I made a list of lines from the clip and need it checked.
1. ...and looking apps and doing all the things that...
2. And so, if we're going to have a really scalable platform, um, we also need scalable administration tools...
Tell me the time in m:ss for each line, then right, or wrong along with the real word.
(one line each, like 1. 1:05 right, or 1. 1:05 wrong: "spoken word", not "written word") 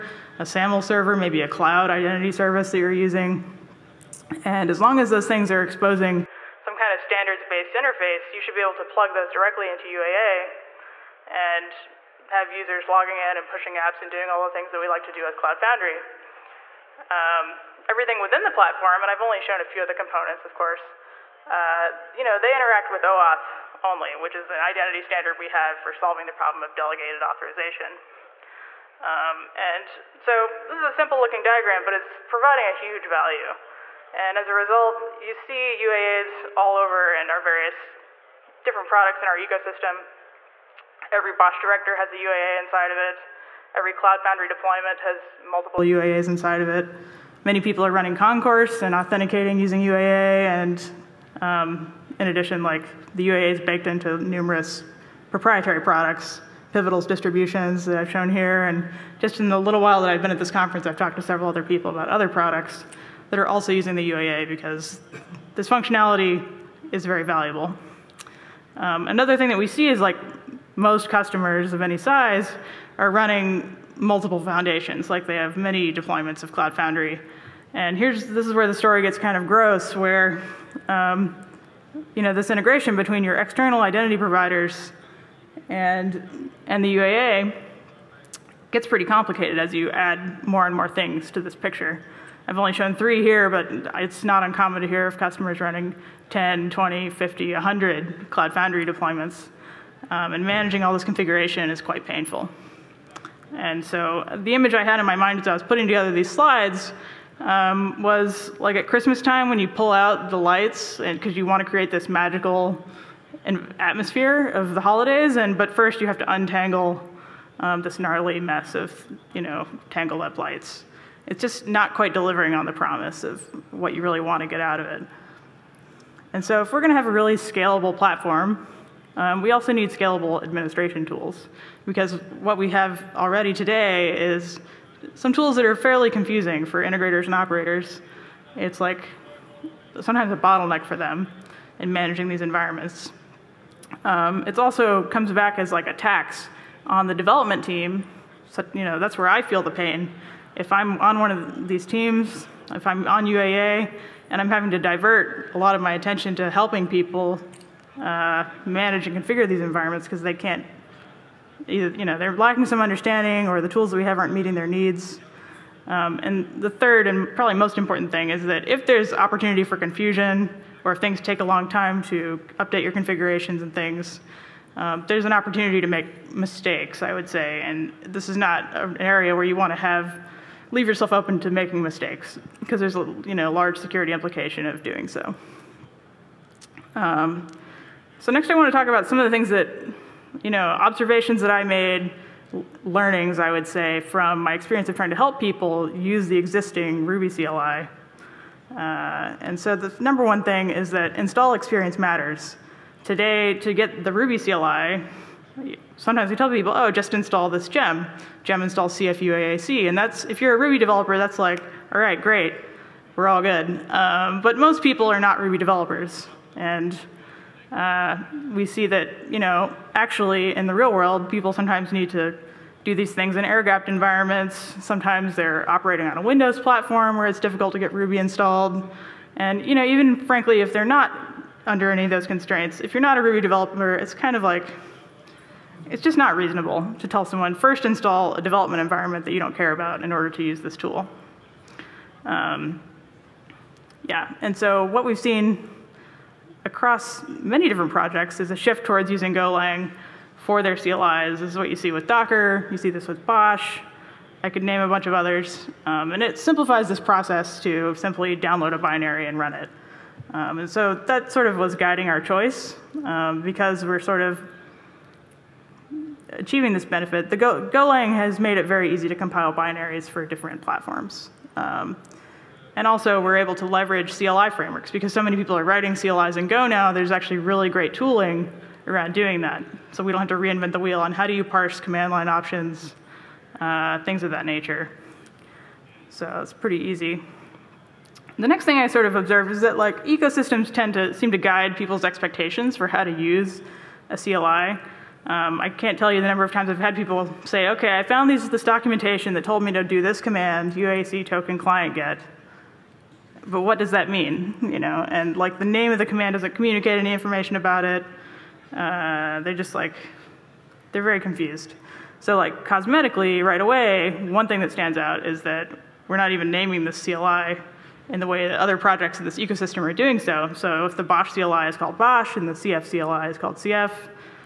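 1. 0:13 wrong: "pushing", not "looking"
2. 2:06 right.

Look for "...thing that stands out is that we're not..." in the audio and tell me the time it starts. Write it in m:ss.
5:14.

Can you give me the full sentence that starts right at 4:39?
So we don't have to reinvent the wheel on how do you parse command line options, uh, things of that nature.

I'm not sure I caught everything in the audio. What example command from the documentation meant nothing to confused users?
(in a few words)
uaac token client get.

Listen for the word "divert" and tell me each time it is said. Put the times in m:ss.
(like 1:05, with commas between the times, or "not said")
2:34.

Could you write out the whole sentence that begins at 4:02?
Um, yeah, and so what we've seen across many different projects is a shift towards using Golang for their CLIs.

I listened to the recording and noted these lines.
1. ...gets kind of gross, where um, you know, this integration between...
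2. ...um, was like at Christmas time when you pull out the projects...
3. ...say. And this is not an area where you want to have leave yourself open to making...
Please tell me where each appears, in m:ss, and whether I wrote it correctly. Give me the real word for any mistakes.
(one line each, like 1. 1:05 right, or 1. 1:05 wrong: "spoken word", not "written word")
1. 1:19 right
2. 1:47 wrong: "lights", not "projects"
3. 2:57 right.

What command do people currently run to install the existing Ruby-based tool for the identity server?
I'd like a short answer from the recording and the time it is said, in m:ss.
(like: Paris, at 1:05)
gem install cf-uaac, at 3:28.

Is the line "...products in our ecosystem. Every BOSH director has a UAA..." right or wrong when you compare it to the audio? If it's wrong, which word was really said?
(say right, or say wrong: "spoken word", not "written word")
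right.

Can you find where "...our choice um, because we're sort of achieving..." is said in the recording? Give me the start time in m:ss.
4:22.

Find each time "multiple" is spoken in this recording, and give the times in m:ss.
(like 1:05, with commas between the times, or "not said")
0:45, 1:13.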